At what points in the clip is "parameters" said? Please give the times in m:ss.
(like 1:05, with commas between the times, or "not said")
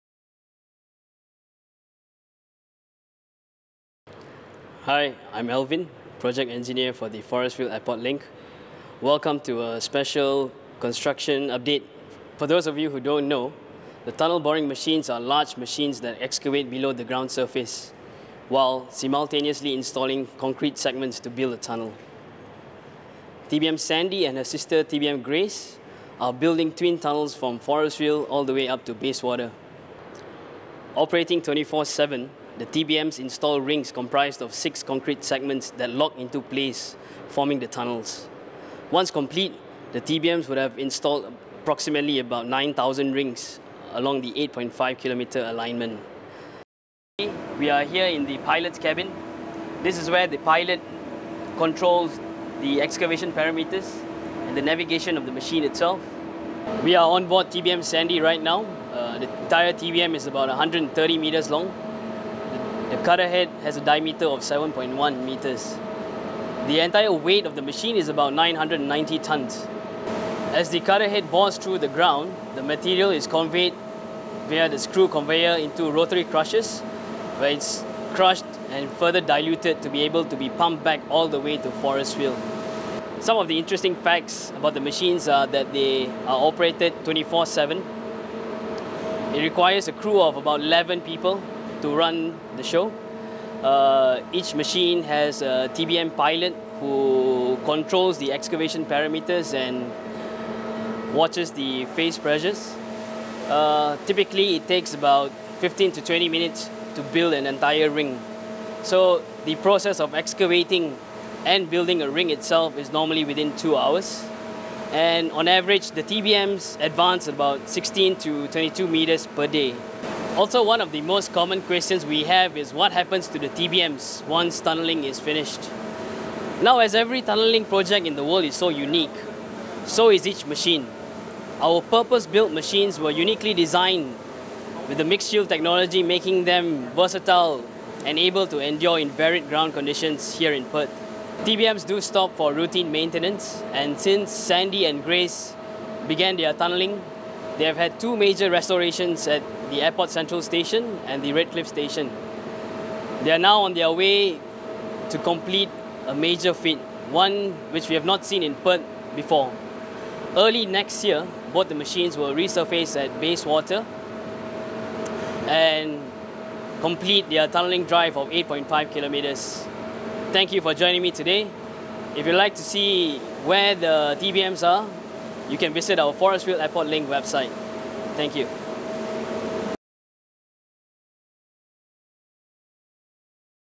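0:53, 1:38.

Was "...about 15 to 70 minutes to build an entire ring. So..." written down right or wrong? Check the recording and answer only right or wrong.
wrong.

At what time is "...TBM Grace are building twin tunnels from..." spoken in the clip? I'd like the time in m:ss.
0:24.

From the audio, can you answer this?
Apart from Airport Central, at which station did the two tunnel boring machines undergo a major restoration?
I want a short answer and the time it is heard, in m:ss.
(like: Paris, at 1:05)
Redcliffe Station, at 2:31.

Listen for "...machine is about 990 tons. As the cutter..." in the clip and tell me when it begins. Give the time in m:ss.
1:07.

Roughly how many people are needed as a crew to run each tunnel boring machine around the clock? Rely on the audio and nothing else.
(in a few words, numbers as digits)
11.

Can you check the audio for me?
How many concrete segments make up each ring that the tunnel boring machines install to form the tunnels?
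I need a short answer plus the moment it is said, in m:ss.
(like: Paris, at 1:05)
6, at 0:34.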